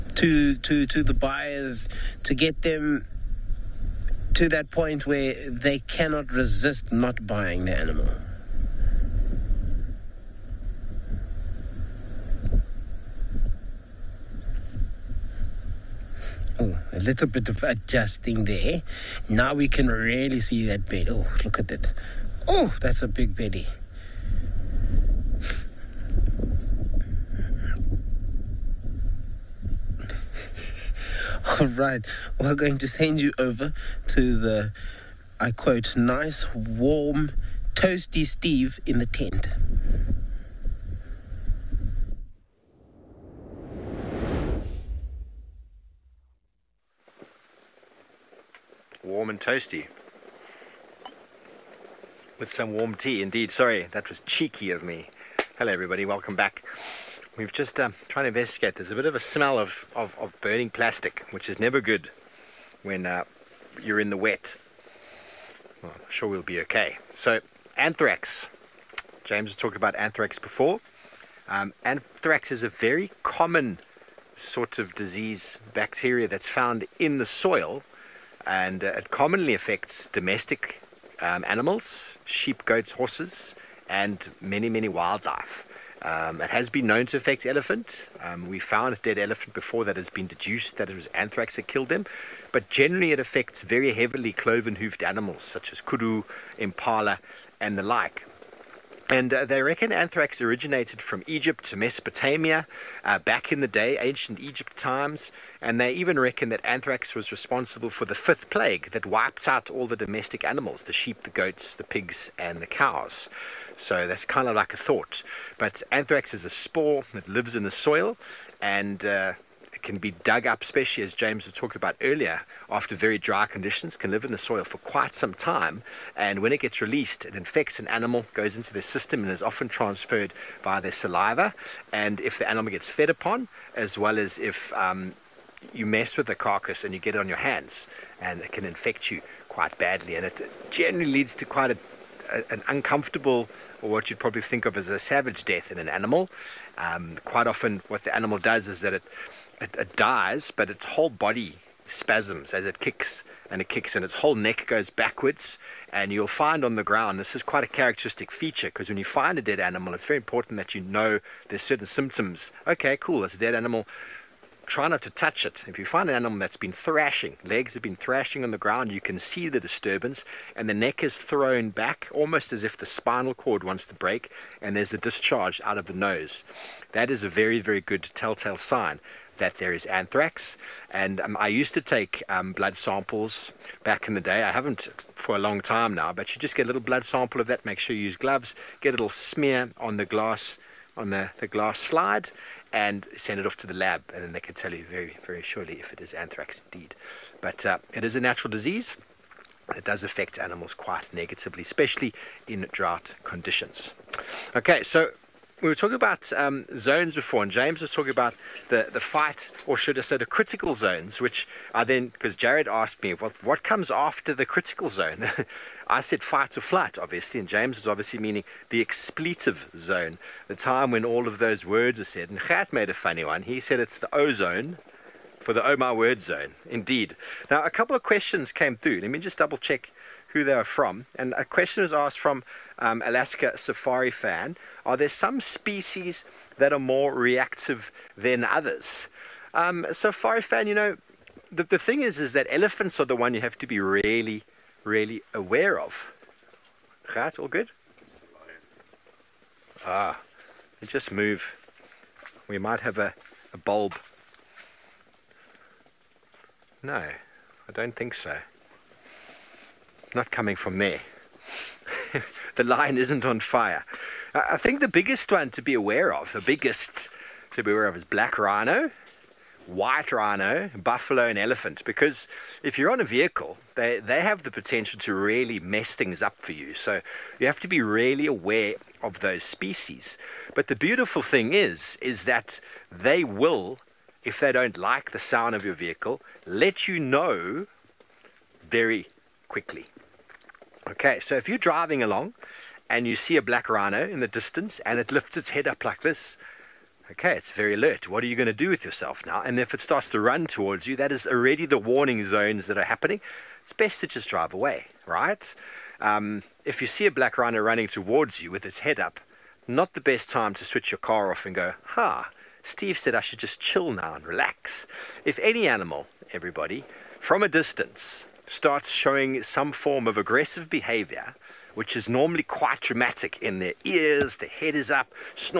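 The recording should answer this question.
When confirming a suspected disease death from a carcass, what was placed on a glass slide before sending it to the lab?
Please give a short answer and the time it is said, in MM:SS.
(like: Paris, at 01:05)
Blood sample, at 03:06.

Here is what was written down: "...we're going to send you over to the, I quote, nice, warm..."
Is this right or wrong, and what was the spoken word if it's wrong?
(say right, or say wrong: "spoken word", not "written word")
right.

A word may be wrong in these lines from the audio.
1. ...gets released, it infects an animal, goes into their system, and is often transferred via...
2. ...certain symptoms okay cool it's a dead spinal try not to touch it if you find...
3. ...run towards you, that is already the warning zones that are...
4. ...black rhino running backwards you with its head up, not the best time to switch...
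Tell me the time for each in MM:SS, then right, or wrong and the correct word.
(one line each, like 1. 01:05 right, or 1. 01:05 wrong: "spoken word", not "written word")
1. 02:06 right
2. 02:41 wrong: "animal", not "spinal"
3. 05:00 right
4. 05:07 wrong: "towards", not "backwards".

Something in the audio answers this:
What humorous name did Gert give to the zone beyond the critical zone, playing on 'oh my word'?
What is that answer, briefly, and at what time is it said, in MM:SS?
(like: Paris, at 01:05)
Ozone, at 03:44.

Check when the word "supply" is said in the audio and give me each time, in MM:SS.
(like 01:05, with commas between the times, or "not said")
not said.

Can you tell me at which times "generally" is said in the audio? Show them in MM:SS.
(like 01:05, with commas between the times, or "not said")
01:32, 02:20.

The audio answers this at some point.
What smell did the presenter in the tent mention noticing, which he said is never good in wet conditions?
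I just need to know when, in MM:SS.
01:00.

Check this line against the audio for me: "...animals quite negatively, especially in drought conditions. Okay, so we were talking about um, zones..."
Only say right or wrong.
right.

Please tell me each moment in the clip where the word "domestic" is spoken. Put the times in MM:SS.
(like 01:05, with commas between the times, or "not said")
01:20, 01:49.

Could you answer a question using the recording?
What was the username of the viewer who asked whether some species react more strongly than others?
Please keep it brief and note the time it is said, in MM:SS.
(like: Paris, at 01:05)
Alaska Safari Fan, at 03:53.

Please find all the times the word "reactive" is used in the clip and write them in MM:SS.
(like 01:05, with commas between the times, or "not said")
03:57.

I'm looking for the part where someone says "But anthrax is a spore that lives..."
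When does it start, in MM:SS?
01:55.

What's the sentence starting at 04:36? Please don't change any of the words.
So you have to be really aware of those species.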